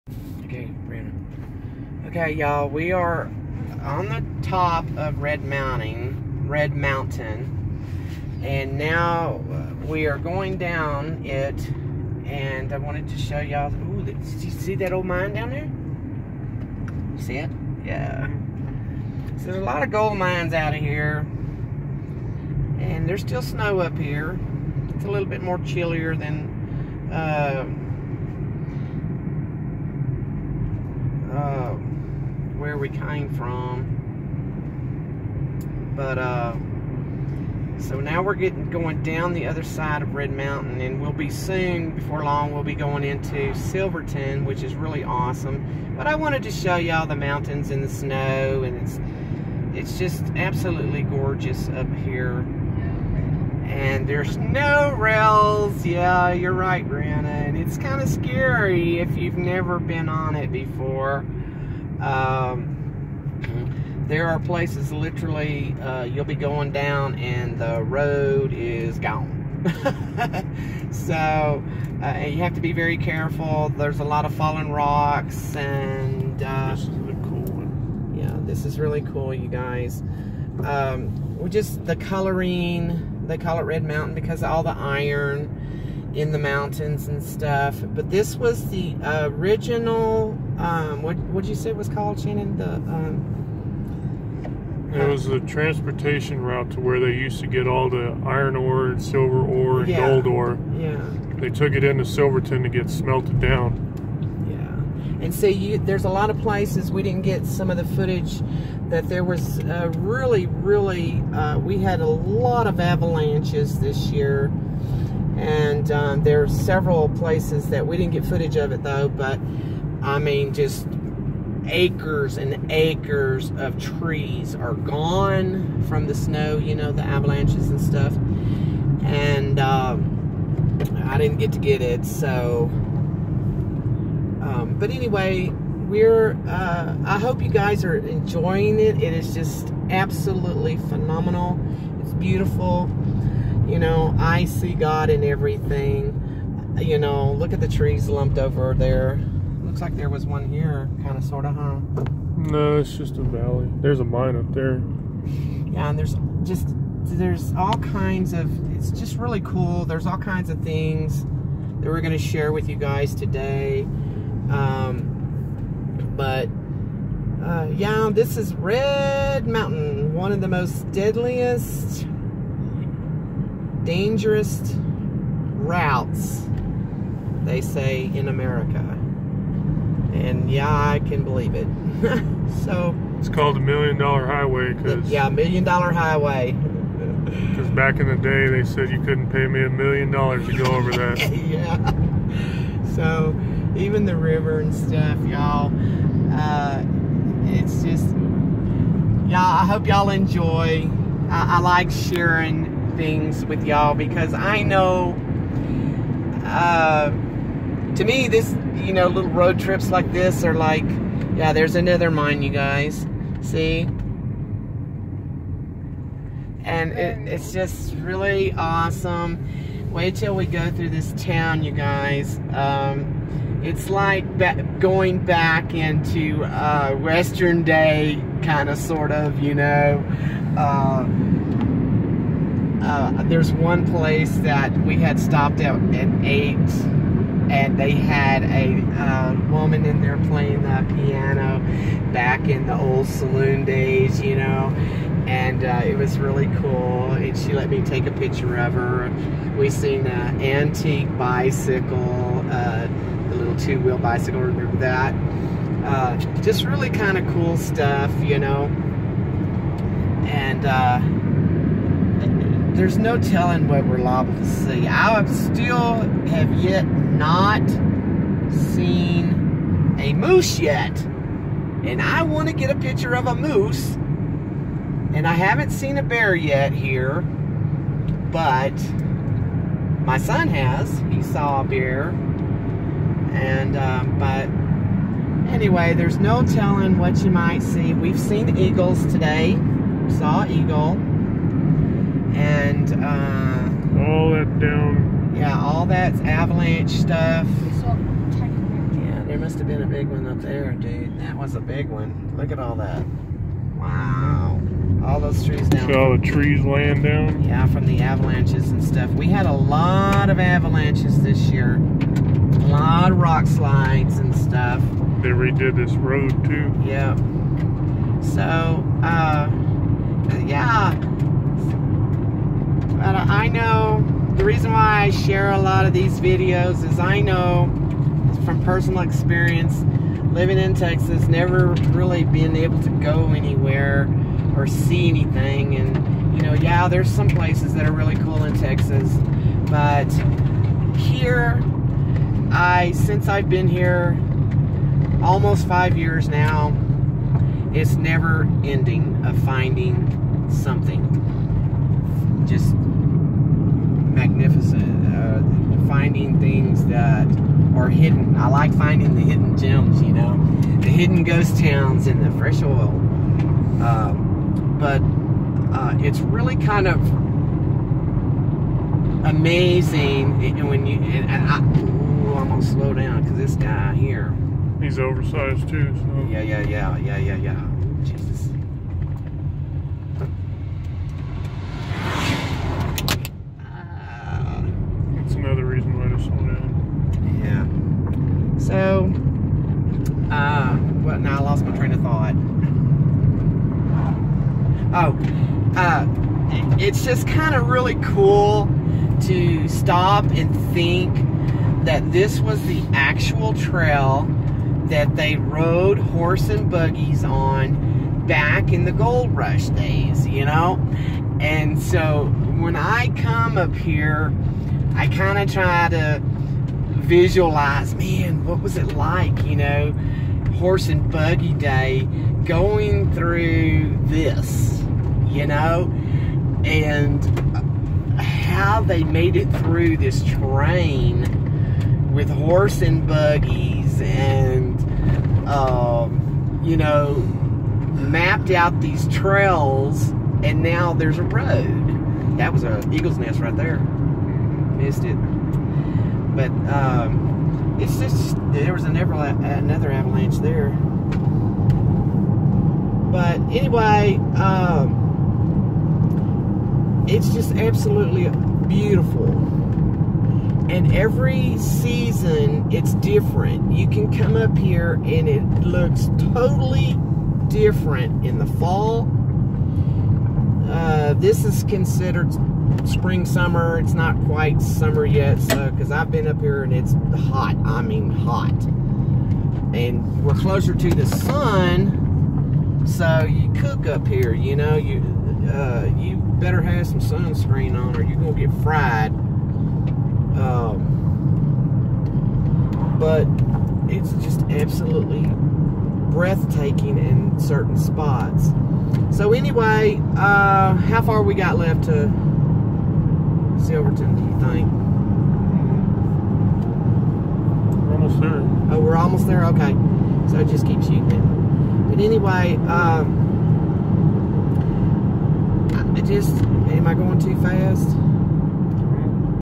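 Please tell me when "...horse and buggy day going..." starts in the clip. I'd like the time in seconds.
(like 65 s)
420 s.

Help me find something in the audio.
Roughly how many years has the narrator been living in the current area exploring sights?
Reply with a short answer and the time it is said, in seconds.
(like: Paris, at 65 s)
5, at 345 s.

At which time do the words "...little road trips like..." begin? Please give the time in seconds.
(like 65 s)
209 s.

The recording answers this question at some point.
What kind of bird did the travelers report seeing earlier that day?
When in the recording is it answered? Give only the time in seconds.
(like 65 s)
287 s.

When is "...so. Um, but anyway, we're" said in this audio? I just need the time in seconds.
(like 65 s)
132 s.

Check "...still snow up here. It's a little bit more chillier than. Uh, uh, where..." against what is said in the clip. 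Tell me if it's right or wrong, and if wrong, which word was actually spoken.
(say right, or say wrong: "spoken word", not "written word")
right.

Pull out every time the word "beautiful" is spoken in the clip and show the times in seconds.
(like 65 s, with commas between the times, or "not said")
142 s, 458 s.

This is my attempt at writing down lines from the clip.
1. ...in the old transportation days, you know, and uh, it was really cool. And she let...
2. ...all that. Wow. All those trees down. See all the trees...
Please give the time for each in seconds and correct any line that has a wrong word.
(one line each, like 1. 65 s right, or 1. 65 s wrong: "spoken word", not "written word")
1. 242 s wrong: "saloon", not "transportation"
2. 302 s right.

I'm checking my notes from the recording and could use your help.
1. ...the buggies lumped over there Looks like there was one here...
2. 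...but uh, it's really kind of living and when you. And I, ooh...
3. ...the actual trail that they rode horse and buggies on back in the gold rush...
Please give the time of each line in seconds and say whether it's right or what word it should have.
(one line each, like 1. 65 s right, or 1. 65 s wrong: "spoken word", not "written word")
1. 147 s wrong: "trees", not "buggies"
2. 364 s wrong: "amazing", not "living"
3. 402 s right.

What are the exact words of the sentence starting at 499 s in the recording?
So anyway, uh, how far we got left to Silverton, do you think?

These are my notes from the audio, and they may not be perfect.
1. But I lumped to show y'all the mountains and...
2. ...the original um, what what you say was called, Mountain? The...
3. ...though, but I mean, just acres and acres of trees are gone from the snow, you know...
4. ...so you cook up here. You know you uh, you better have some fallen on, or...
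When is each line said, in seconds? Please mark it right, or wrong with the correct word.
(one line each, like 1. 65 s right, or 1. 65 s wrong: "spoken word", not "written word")
1. 45 s wrong: "wanted", not "lumped"
2. 88 s wrong: "Shannon", not "Mountain"
3. 118 s right
4. 482 s wrong: "sunscreen", not "fallen".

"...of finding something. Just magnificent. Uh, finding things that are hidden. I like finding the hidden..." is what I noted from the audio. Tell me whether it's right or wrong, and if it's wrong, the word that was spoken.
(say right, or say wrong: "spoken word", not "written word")
right.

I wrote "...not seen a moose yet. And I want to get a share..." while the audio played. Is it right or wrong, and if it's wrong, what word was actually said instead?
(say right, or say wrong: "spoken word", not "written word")
wrong: "picture", not "share".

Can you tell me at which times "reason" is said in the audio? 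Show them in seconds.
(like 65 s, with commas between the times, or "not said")
324 s.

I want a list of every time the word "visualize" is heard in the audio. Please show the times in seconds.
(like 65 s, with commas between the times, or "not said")
416 s.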